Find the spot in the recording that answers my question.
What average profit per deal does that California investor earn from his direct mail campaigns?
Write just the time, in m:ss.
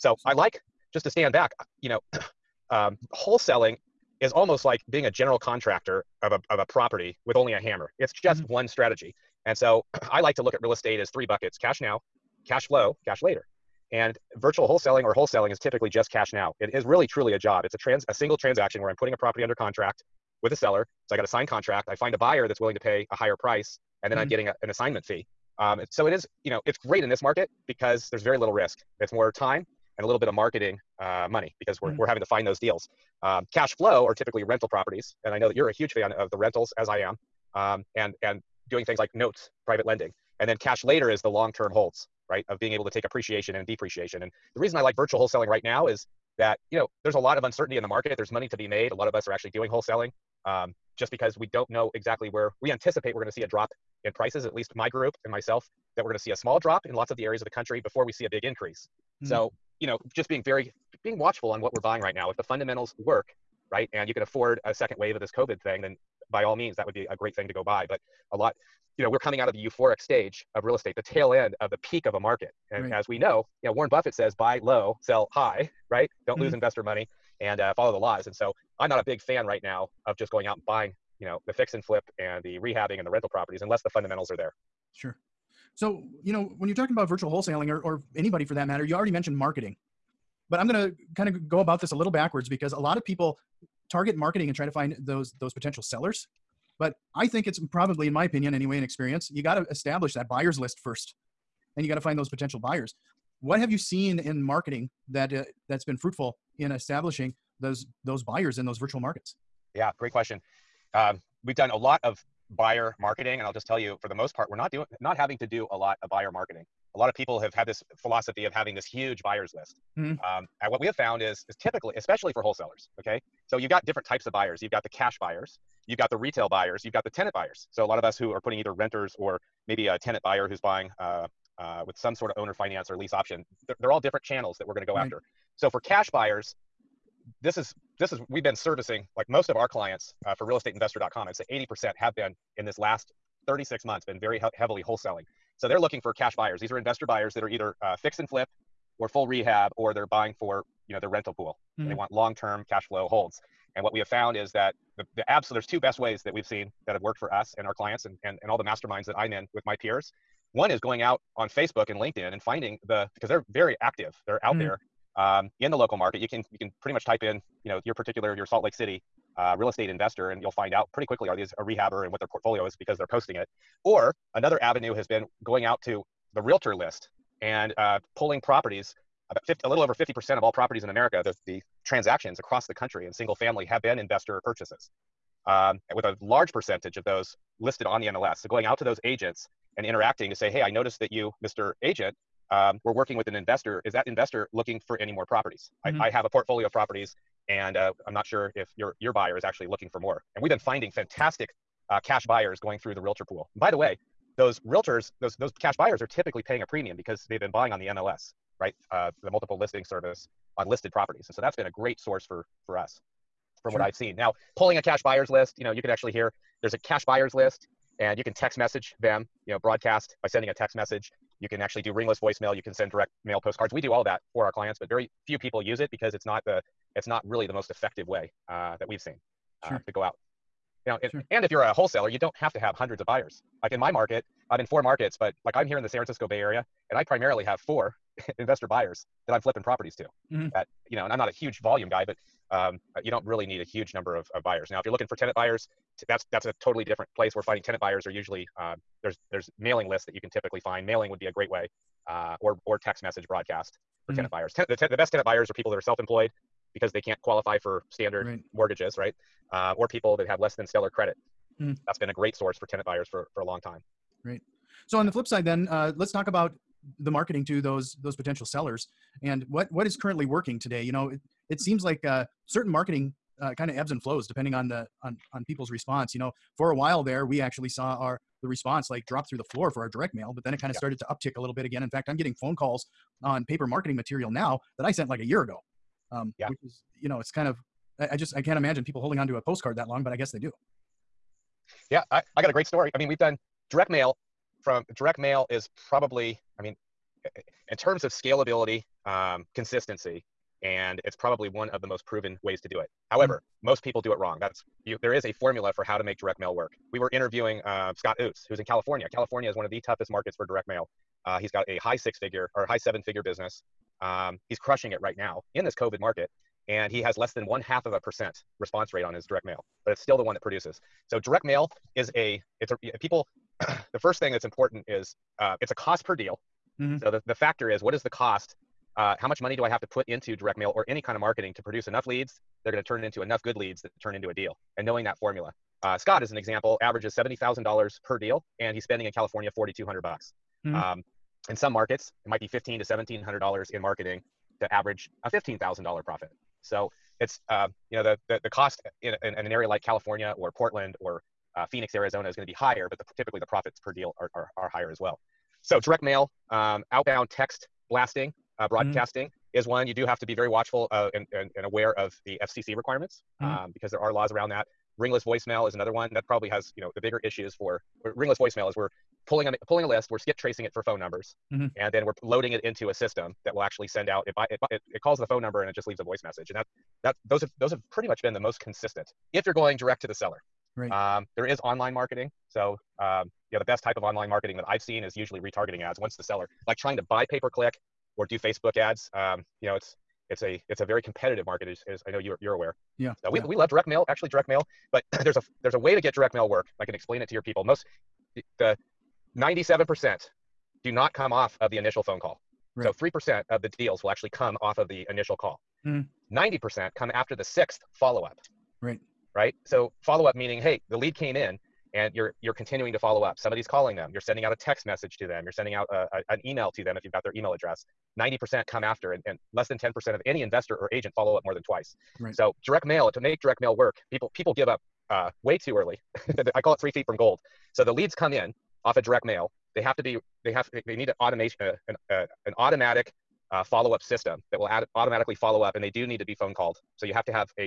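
5:37.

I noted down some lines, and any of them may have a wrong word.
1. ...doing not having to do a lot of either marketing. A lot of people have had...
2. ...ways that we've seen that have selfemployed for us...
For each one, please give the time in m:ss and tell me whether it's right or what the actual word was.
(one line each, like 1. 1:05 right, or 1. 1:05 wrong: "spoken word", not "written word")
1. 1:54 wrong: "buyer", not "either"
2. 2:35 wrong: "worked", not "selfemployed".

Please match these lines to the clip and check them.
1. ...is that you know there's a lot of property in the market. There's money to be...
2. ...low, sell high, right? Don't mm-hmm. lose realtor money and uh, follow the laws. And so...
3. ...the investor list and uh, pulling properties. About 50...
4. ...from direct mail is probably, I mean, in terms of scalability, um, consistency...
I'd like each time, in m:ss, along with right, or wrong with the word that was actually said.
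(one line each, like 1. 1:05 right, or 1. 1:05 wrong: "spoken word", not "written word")
1. 0:45 wrong: "uncertainty", not "property"
2. 1:14 wrong: "investor", not "realtor"
3. 2:56 wrong: "realtor", not "investor"
4. 4:54 right.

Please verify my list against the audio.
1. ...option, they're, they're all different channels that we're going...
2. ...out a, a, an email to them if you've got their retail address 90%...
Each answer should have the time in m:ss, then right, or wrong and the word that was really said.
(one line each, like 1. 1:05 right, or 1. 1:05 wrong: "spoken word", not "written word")
1. 2:13 right
2. 6:55 wrong: "email", not "retail".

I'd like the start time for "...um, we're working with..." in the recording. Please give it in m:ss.
3:12.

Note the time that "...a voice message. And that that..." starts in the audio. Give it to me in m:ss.
6:15.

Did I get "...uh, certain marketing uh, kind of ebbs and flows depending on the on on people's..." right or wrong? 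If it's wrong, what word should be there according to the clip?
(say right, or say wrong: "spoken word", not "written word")
right.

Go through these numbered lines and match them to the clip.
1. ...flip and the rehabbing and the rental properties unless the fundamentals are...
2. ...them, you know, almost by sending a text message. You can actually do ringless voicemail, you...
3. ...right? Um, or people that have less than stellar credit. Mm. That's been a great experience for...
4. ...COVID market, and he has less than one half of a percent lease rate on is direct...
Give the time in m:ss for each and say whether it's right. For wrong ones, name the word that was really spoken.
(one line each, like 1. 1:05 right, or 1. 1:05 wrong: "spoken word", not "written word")
1. 1:21 right
2. 3:38 wrong: "broadcast", not "almost"
3. 4:18 wrong: "source", not "experience"
4. 5:15 wrong: "response", not "lease".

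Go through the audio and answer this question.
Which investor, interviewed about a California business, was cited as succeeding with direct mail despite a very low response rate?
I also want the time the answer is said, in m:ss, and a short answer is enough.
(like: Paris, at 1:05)
Scott Oots, at 5:07.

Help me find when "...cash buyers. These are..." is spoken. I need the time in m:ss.
2:26.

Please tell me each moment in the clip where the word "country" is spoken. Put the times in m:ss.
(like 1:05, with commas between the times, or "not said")
0:57, 3:02.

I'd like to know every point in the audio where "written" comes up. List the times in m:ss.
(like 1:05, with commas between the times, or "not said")
not said.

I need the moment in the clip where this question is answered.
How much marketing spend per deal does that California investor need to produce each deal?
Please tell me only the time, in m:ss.
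5:39.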